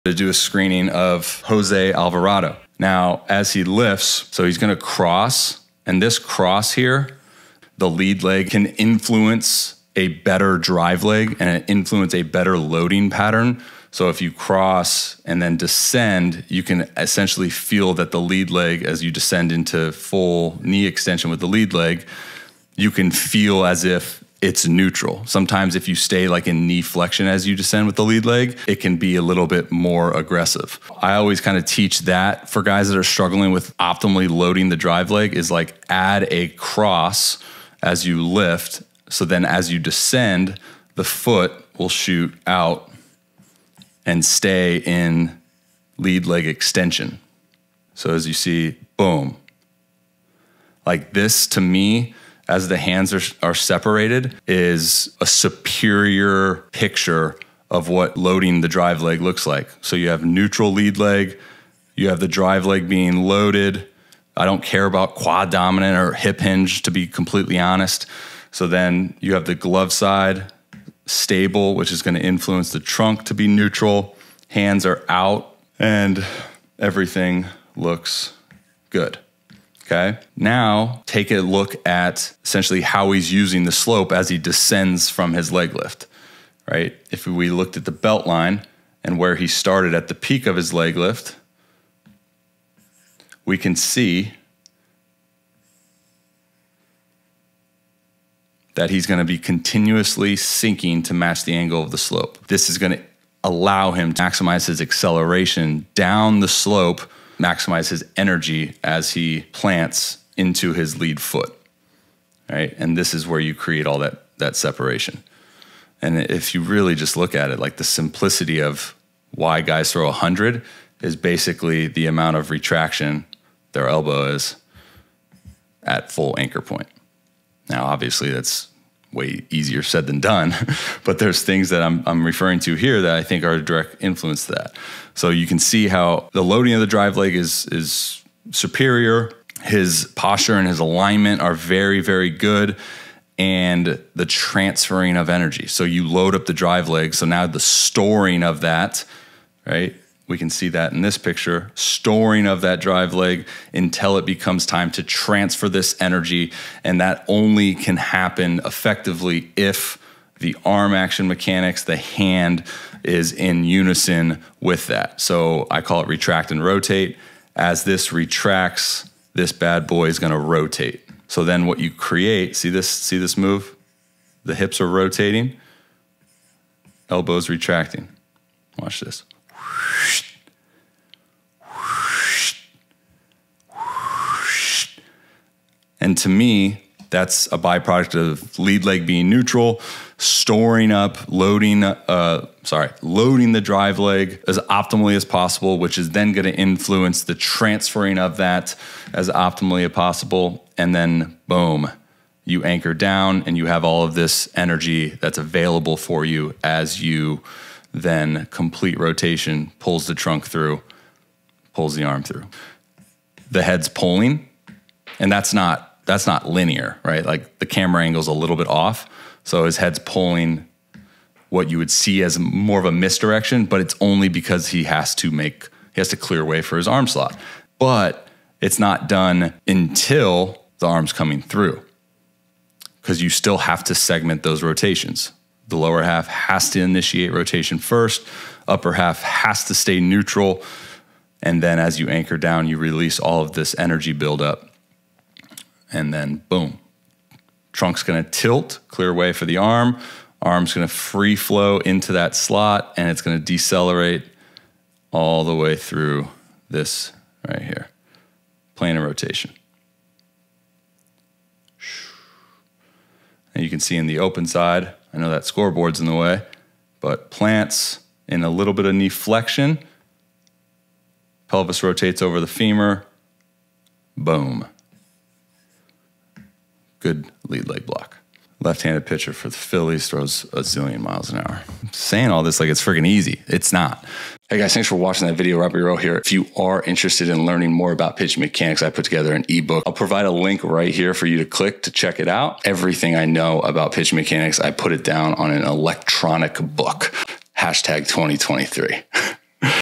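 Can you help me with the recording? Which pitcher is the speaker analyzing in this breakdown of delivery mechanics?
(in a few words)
Jose Alvarado.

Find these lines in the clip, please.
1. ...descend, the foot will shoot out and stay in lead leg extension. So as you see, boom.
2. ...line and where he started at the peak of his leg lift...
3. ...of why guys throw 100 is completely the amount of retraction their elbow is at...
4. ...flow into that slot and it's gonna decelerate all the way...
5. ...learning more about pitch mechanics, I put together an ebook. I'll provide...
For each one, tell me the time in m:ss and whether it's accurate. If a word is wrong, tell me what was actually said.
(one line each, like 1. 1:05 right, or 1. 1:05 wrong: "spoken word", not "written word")
1. 0:39 right
2. 1:28 right
3. 1:58 wrong: "basically", not "completely"
4. 4:11 right
5. 4:47 right.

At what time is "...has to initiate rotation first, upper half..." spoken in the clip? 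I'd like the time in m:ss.
3:56.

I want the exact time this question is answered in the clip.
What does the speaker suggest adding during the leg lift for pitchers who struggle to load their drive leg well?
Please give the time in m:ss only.
0:35.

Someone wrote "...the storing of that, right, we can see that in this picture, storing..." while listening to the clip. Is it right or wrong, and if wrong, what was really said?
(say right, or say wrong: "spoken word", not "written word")
right.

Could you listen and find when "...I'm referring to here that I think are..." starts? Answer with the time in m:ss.
2:12.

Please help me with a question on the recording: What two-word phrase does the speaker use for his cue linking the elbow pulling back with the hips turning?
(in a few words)
retract and rotate.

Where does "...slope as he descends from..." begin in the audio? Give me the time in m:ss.
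1:23.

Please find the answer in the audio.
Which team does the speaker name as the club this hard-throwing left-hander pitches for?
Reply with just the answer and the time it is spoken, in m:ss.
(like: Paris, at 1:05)
Phillies, at 4:39.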